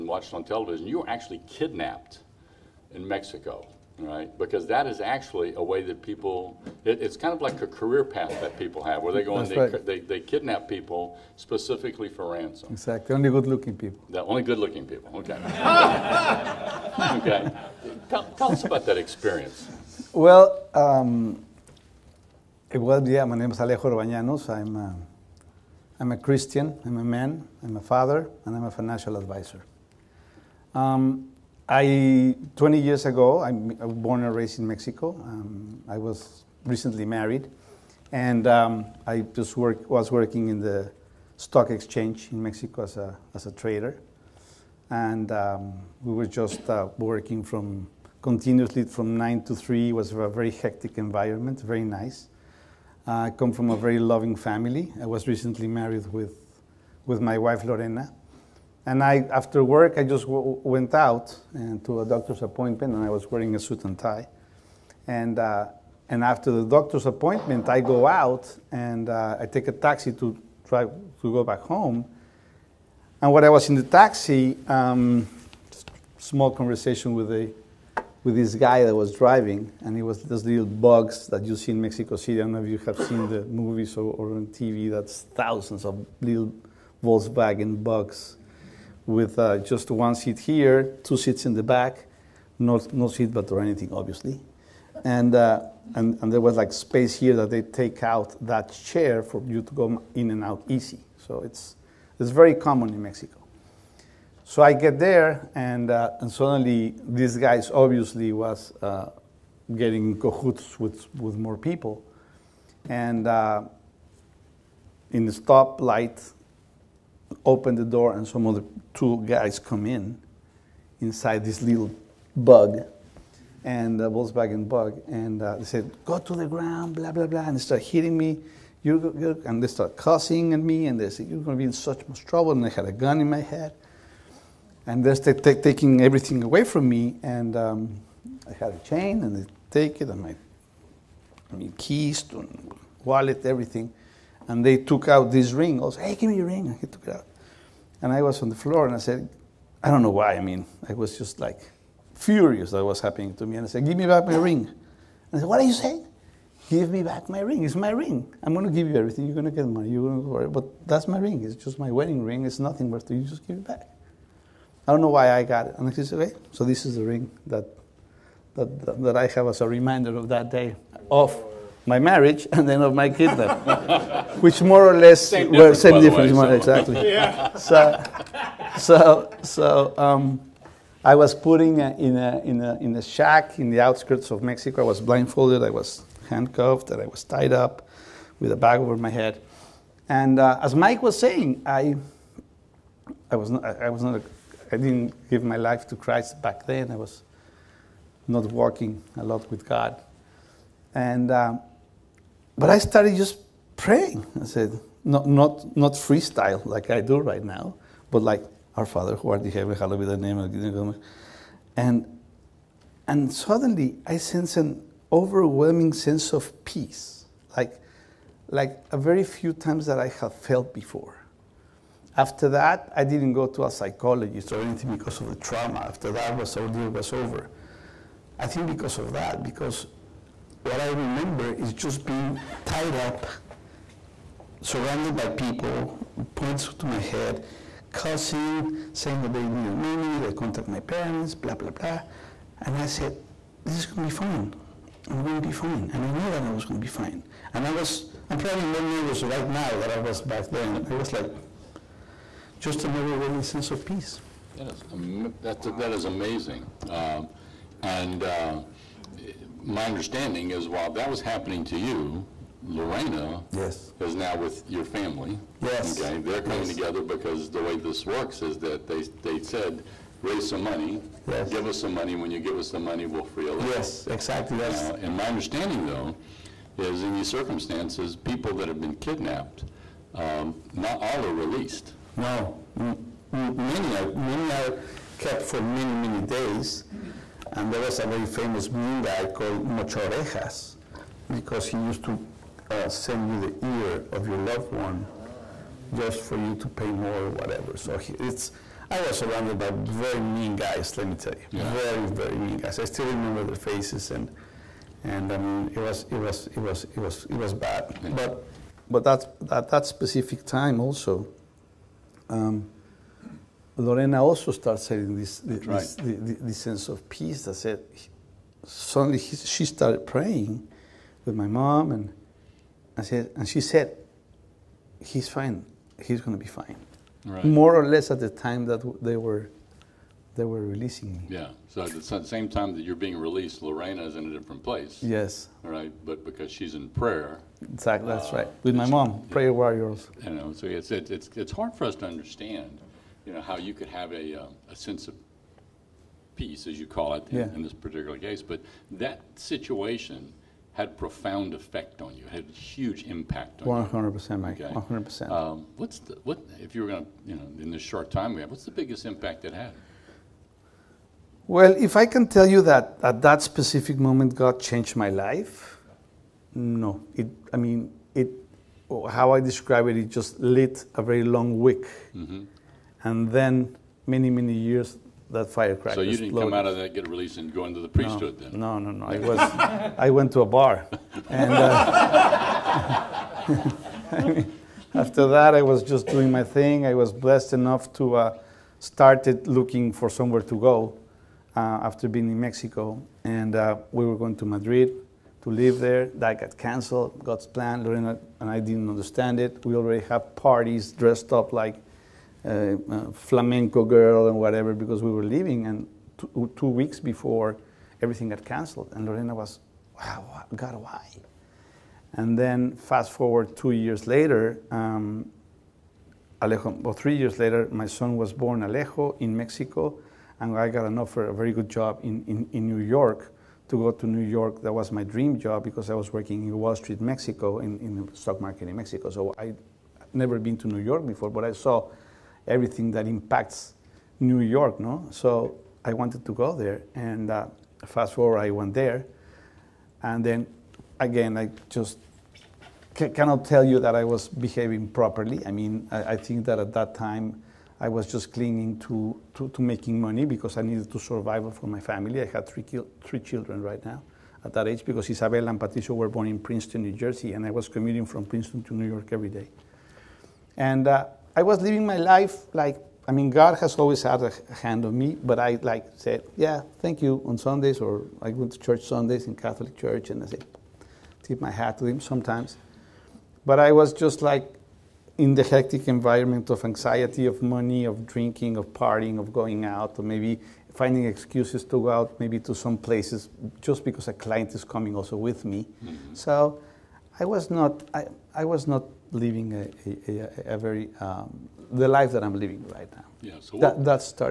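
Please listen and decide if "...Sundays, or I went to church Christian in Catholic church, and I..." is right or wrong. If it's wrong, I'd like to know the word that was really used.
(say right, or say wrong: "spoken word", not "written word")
wrong: "Sundays", not "Christian".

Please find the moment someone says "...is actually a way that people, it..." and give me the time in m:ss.
0:04.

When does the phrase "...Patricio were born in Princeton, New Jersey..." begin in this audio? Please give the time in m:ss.
7:35.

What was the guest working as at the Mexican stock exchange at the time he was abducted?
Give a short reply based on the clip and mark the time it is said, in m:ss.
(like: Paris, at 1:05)
Trader, at 0:43.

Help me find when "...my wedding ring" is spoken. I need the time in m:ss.
2:41.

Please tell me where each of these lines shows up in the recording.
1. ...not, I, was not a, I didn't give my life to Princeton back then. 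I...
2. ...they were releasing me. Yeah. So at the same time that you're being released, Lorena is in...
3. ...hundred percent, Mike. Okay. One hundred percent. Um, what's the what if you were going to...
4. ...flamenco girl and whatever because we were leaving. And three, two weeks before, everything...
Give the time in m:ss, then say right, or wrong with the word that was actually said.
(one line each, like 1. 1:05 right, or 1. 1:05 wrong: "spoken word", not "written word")
1. 3:13 wrong: "Christ", not "Princeton"
2. 5:30 right
3. 5:53 right
4. 6:43 wrong: "two", not "three".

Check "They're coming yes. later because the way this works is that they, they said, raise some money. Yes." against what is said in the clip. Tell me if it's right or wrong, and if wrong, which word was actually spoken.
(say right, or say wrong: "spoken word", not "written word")
wrong: "together", not "later".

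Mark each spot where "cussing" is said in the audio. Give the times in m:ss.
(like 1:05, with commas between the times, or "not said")
2:09, 3:57.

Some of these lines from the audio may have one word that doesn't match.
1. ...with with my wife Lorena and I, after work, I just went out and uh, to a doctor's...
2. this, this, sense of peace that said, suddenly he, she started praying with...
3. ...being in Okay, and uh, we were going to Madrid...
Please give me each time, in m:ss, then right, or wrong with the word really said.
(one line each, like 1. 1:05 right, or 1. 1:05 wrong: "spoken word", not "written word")
1. 0:56 right
2. 5:16 right
3. 6:32 wrong: "Mexico", not "Okay".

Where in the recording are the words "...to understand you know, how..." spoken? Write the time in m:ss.
5:41.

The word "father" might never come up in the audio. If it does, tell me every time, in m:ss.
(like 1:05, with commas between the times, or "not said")
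0:27, 3:28.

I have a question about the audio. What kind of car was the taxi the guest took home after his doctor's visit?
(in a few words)
Volkswagen bug.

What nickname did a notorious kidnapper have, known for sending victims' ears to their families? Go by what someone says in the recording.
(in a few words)
Mocho Orejas.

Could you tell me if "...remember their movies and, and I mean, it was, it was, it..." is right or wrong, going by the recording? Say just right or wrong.
wrong.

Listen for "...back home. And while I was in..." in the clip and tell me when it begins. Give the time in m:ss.
1:11.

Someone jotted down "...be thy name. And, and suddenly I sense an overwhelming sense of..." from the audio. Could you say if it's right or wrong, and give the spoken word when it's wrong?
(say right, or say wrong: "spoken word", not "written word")
right.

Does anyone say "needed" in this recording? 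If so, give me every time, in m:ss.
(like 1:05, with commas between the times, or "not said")
3:59, 7:30.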